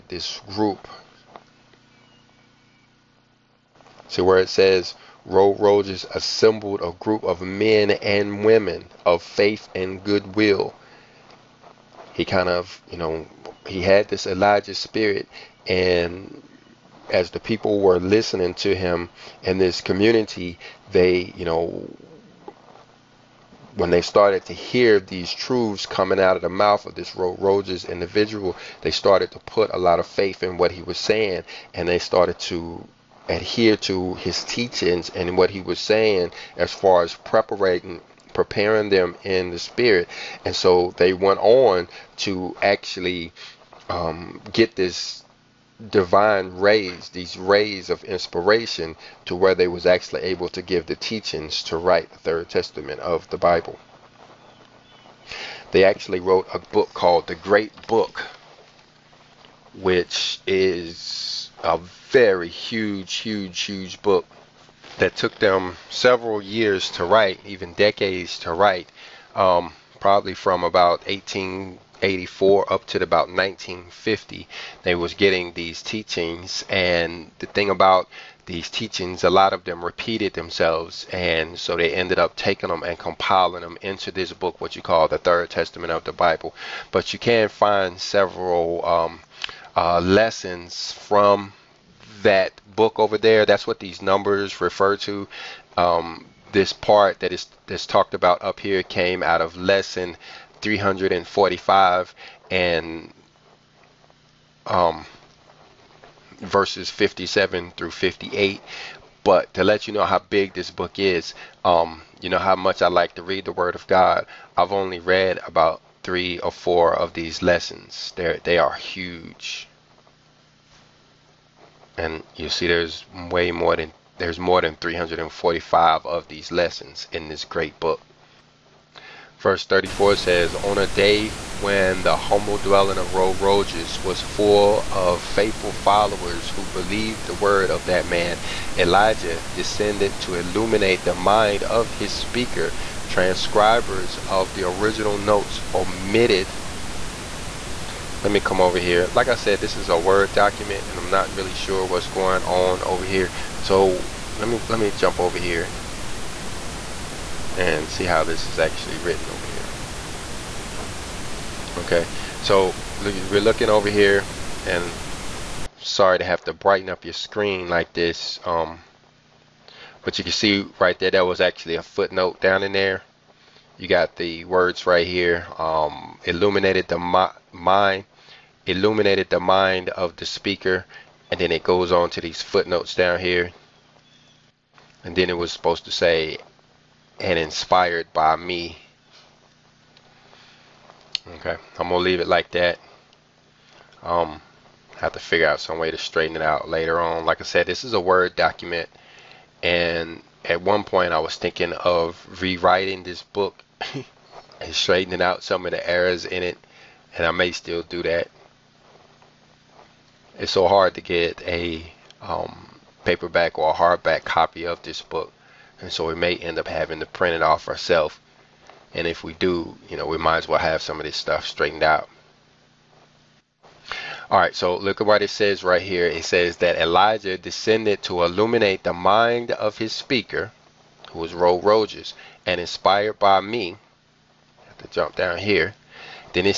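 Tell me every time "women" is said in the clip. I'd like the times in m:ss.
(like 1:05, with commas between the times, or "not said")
0:08.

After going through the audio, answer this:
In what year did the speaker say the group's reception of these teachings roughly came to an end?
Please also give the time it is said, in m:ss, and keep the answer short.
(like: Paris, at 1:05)
1950, at 1:13.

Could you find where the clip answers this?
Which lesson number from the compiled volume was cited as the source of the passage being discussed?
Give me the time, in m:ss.
1:39.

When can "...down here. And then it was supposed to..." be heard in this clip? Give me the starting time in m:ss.
3:02.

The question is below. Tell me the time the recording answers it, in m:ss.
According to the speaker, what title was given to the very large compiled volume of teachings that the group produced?
0:57.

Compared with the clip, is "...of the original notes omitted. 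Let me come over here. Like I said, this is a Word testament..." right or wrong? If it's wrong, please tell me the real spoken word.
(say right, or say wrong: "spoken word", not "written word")
wrong: "document", not "testament".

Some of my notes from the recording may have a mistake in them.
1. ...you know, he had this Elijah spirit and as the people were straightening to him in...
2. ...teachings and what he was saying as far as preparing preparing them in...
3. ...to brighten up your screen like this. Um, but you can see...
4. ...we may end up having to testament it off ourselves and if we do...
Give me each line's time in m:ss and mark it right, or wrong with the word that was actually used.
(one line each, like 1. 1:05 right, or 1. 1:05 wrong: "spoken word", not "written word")
1. 0:12 wrong: "listening", not "straightening"
2. 0:34 right
3. 2:46 right
4. 3:36 wrong: "print", not "testament".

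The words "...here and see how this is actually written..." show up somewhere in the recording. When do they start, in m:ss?
2:35.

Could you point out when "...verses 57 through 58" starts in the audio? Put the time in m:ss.
1:46.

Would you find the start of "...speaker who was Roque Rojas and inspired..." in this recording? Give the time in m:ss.
3:49.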